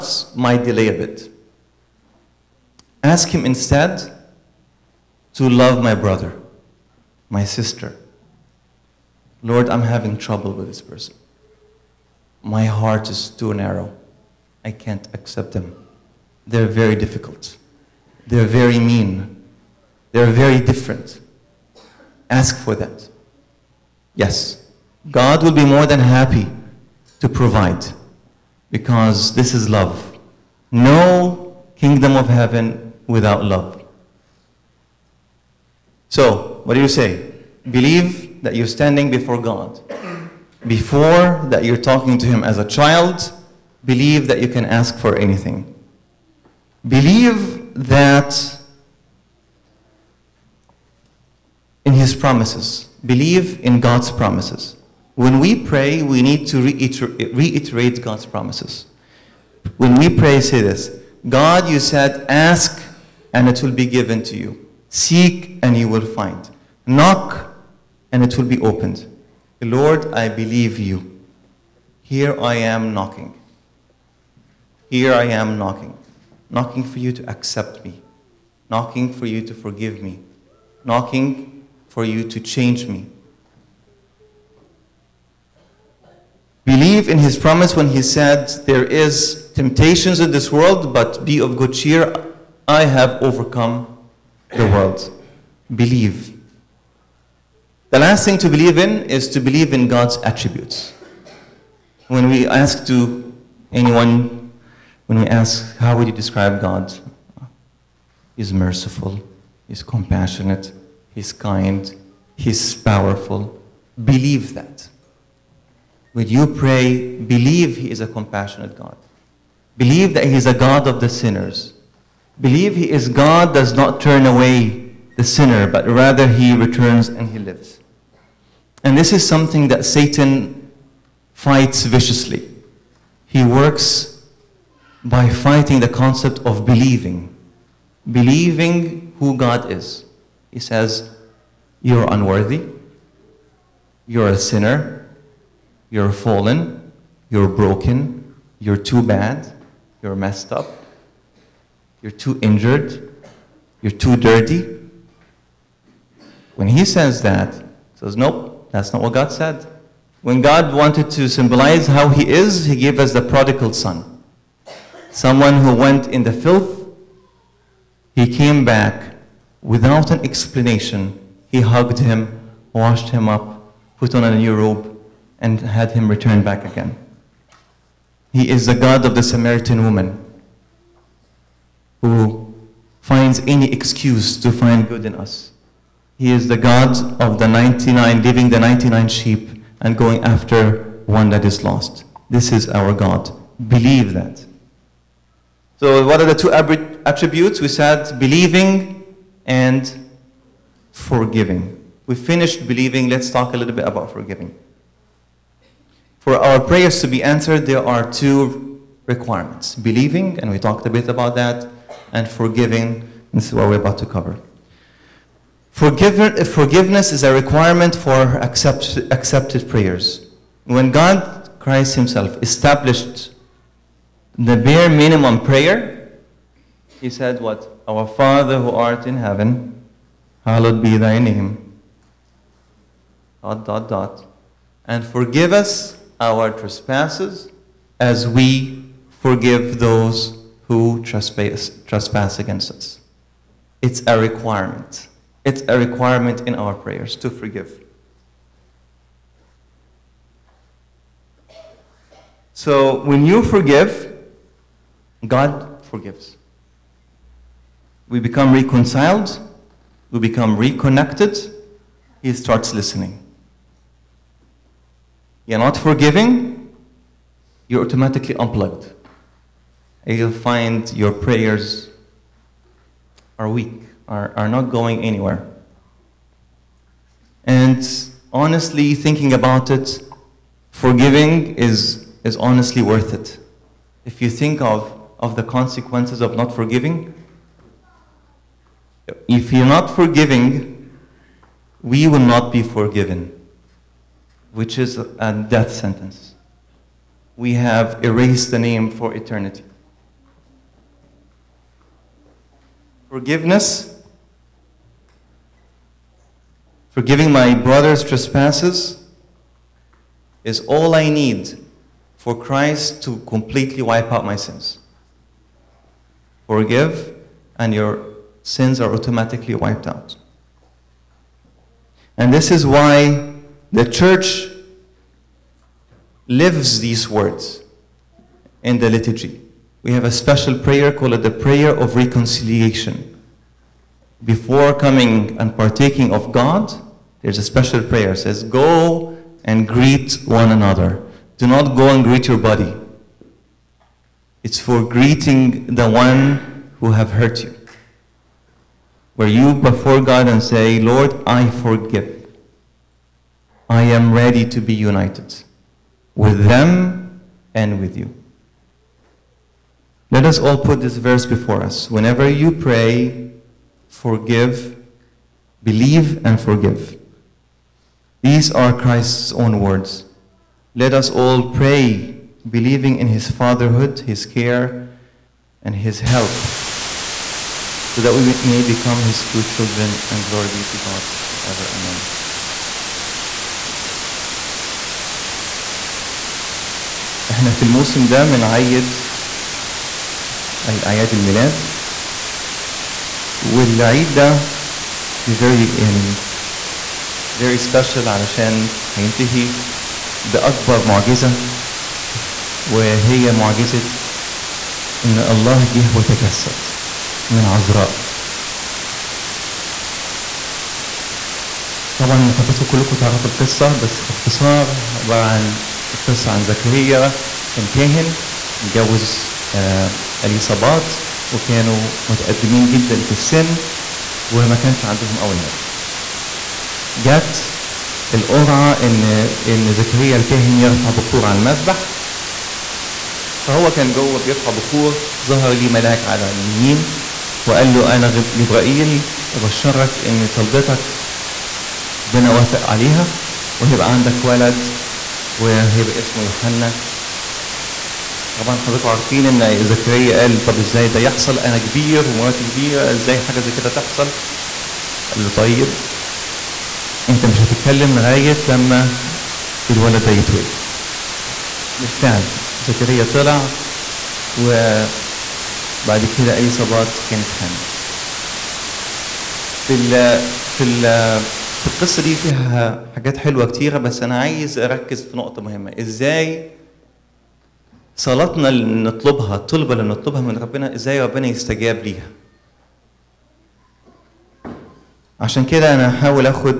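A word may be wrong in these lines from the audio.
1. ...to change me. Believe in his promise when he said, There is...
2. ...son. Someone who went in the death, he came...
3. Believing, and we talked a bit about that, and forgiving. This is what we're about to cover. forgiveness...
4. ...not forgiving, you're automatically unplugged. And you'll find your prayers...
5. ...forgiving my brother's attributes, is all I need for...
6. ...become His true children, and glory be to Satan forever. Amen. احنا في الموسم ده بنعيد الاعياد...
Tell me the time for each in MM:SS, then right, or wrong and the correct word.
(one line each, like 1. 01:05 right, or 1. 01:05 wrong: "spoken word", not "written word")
1. 01:22 right
2. 02:43 wrong: "filth", not "death"
3. 03:29 right
4. 04:25 right
5. 05:06 wrong: "trespasses", not "attributes"
6. 06:18 wrong: "God", not "Satan".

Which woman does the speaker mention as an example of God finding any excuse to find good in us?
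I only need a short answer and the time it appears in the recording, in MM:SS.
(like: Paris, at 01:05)
The Samaritan woman, at 02:59.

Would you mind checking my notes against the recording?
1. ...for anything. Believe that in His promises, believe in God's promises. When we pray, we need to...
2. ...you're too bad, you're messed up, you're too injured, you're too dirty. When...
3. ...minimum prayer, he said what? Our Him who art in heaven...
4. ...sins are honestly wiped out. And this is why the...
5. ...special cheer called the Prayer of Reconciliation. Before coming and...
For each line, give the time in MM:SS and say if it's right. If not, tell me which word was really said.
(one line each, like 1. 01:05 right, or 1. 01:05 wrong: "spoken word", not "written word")
1. 00:44 right
2. 02:28 right
3. 03:44 wrong: "Father", not "Him"
4. 05:18 wrong: "automatically", not "honestly"
5. 05:30 wrong: "prayer", not "cheer".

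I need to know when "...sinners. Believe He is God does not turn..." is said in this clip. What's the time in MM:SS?
02:01.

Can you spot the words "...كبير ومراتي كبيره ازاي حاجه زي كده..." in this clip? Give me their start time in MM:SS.
07:31.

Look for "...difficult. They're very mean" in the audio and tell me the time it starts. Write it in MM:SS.
00:16.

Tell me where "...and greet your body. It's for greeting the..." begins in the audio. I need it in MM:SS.
05:41.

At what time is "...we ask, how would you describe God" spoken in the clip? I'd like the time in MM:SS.
01:45.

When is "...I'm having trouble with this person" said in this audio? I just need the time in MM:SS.
00:09.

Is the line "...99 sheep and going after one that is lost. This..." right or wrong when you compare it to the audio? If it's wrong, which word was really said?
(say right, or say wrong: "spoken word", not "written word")
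right.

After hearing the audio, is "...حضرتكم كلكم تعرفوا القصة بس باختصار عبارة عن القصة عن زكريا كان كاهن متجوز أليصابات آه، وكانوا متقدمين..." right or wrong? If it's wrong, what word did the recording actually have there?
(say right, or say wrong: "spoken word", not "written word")
right.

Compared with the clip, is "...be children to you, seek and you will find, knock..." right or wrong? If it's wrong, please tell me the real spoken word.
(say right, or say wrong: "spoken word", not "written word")
wrong: "given", not "children".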